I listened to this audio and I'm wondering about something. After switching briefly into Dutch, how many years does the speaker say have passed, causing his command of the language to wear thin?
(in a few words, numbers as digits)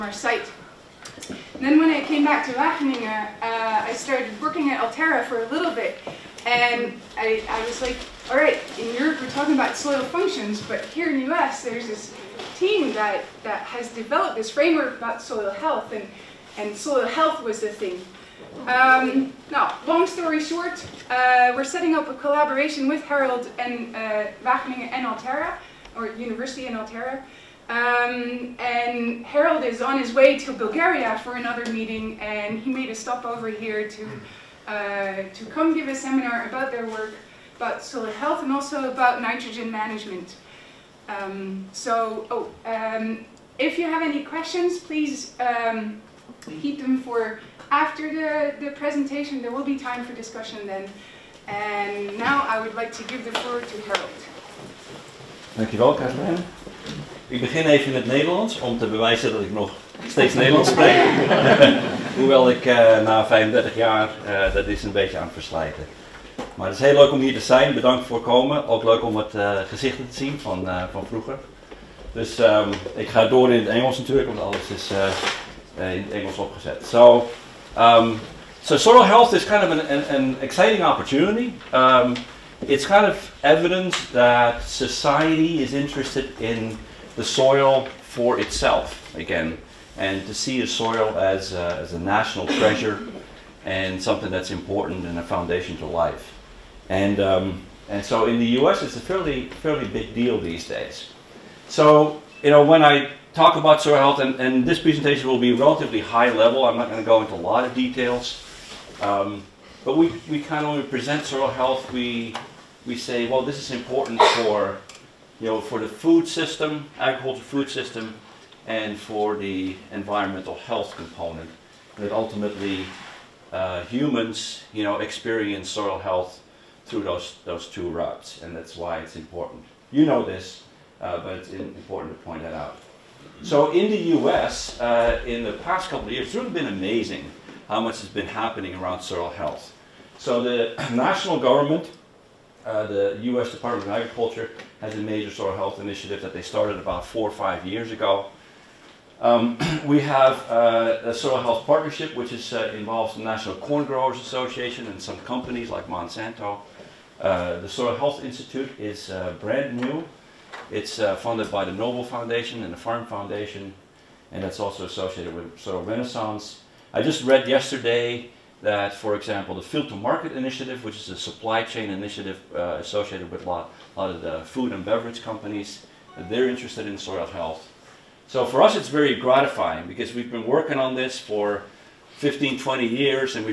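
35.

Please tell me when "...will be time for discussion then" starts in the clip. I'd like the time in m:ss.
0:49.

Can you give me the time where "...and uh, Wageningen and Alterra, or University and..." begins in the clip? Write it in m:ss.
0:23.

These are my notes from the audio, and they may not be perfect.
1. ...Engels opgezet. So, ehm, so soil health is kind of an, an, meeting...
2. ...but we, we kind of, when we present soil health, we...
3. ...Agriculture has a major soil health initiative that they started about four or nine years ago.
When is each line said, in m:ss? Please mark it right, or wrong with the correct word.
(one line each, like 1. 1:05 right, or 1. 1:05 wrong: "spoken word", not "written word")
1. 1:16 wrong: "exciting", not "meeting"
2. 1:49 right
3. 2:23 wrong: "five", not "nine".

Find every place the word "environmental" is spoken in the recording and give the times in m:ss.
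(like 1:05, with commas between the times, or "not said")
1:59.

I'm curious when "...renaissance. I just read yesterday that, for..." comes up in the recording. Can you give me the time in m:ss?
2:45.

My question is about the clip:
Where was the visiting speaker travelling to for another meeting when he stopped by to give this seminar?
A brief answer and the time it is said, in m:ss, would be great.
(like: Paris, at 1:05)
Bulgaria, at 0:30.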